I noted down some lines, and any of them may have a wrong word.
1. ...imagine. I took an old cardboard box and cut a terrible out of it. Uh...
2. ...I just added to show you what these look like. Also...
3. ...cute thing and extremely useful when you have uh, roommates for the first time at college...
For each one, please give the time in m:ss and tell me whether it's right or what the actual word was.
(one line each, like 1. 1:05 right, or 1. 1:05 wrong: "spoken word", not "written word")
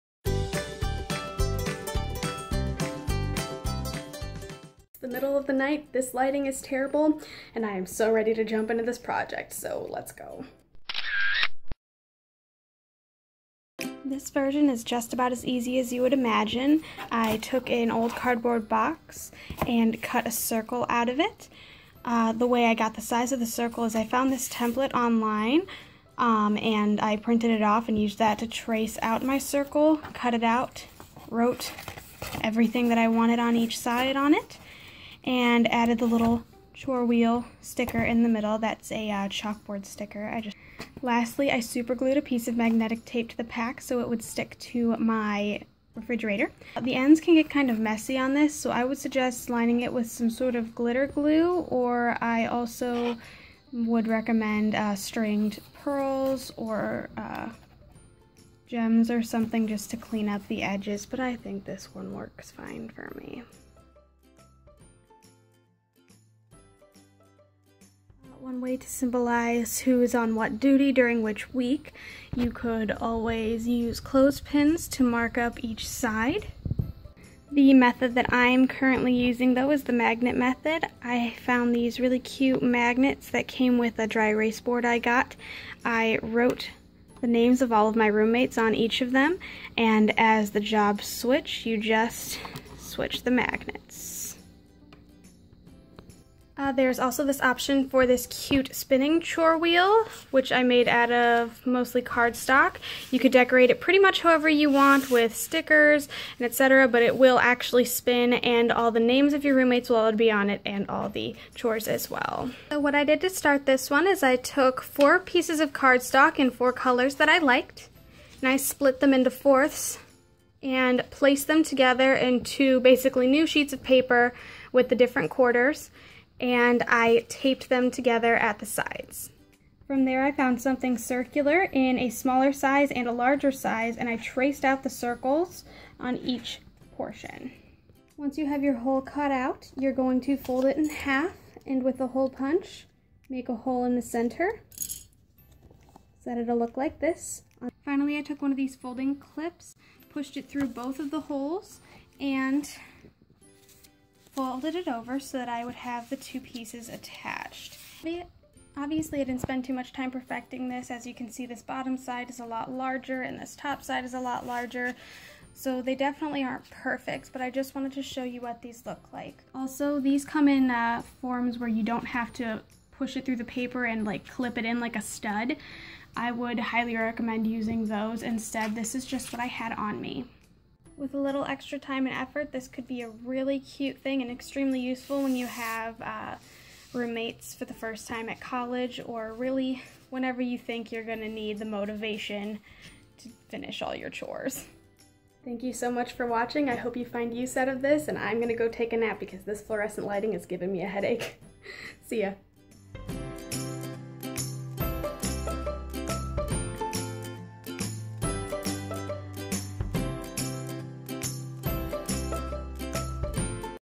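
1. 0:16 wrong: "circle", not "terrible"
2. 2:47 wrong: "wanted", not "added"
3. 3:03 right.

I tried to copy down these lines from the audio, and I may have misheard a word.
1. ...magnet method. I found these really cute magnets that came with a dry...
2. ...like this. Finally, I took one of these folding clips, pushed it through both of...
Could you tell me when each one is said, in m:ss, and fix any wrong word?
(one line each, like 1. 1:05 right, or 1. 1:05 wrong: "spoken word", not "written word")
1. 1:19 right
2. 2:26 right.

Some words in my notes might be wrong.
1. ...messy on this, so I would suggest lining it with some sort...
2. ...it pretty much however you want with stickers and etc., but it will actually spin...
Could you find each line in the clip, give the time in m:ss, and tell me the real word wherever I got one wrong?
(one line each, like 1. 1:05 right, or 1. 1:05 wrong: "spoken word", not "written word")
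1. 0:47 right
2. 1:43 right.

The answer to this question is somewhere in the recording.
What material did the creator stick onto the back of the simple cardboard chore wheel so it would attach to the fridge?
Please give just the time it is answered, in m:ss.
0:42.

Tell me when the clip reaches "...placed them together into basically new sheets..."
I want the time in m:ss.
2:01.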